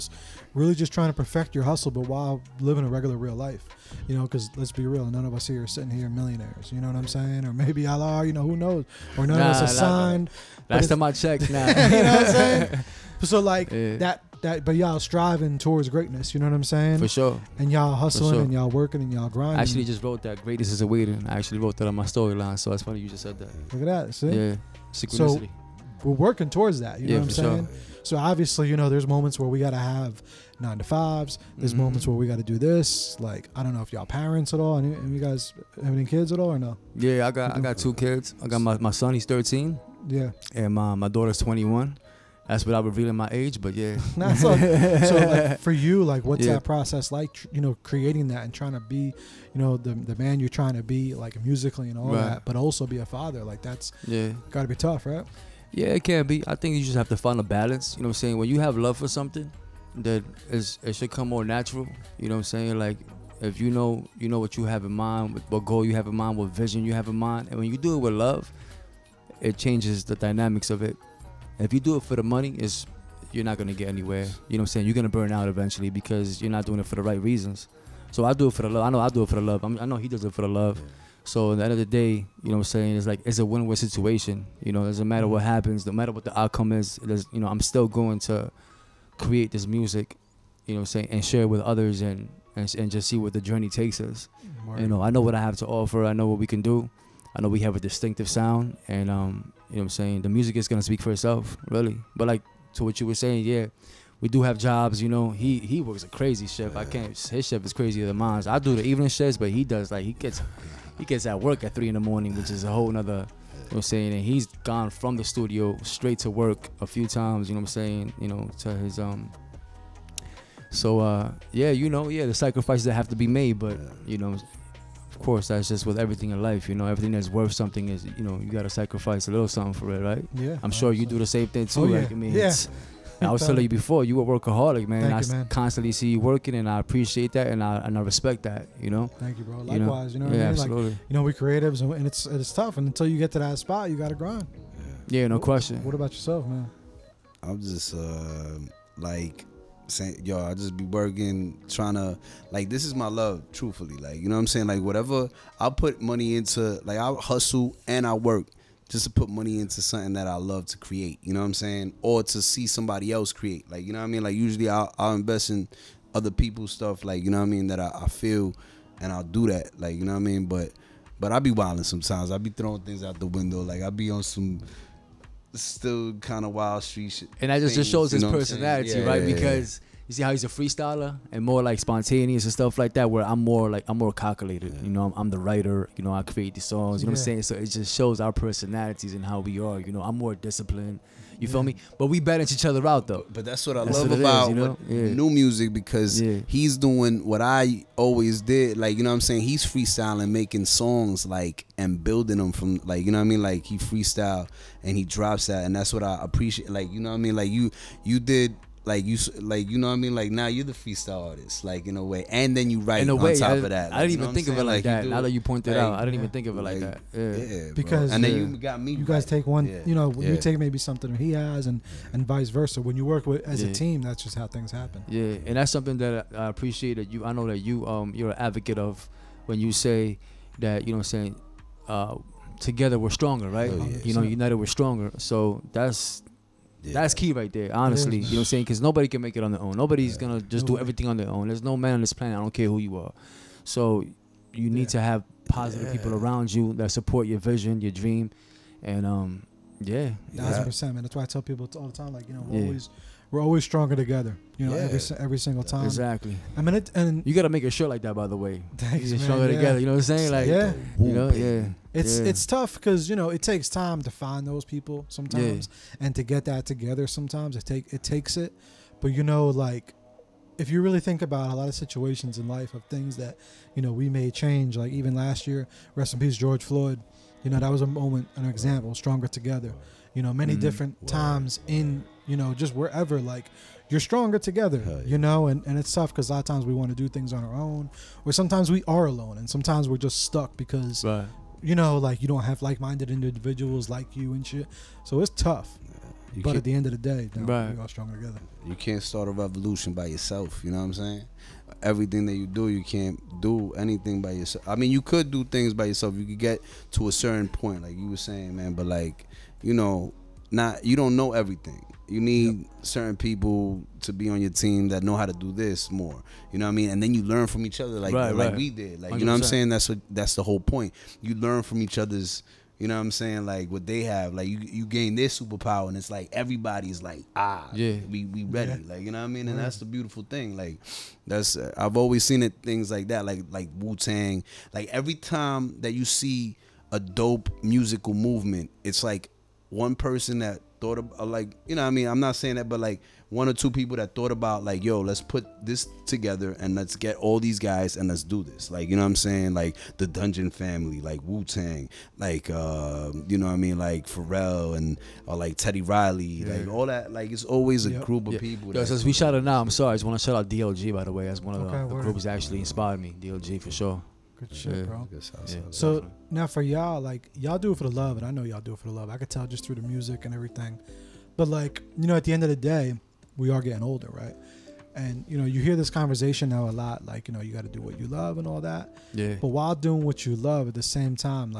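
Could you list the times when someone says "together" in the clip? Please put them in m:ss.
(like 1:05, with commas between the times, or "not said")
3:52, 4:13, 4:19, 4:26, 4:39, 4:44, 4:58, 5:46.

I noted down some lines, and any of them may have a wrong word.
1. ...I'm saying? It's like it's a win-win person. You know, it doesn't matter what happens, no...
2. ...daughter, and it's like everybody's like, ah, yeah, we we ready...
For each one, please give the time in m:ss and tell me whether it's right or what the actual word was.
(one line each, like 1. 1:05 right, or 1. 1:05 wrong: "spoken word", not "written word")
1. 1:22 wrong: "situation", not "person"
2. 5:25 wrong: "superpower", not "daughter".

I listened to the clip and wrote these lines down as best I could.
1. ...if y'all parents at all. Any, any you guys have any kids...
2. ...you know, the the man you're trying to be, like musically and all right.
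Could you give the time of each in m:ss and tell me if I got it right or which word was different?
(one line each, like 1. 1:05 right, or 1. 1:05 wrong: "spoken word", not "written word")
1. 0:33 right
2. 0:48 right.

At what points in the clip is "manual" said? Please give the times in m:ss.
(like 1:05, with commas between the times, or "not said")
not said.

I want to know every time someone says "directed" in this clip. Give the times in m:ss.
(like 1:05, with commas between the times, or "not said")
not said.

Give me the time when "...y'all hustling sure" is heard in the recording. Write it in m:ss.
0:17.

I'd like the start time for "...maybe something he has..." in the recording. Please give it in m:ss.
3:40.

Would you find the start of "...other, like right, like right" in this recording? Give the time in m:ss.
5:17.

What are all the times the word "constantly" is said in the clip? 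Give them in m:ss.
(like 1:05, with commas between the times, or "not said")
2:15.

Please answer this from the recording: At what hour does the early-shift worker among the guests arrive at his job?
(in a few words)
3 in the morning.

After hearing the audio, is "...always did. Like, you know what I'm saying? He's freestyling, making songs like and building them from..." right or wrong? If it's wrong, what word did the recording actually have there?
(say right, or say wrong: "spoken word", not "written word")
right.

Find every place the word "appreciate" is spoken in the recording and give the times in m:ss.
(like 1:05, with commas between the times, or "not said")
2:16, 3:26, 3:46.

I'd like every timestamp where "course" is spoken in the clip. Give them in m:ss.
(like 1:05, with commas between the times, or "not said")
2:05.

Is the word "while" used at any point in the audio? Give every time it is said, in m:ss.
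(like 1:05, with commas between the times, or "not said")
0:02, 6:19.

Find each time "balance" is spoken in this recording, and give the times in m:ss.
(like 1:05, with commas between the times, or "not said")
0:57, 3:12.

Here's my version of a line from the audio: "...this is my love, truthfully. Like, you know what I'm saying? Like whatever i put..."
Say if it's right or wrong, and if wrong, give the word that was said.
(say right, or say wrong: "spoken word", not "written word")
right.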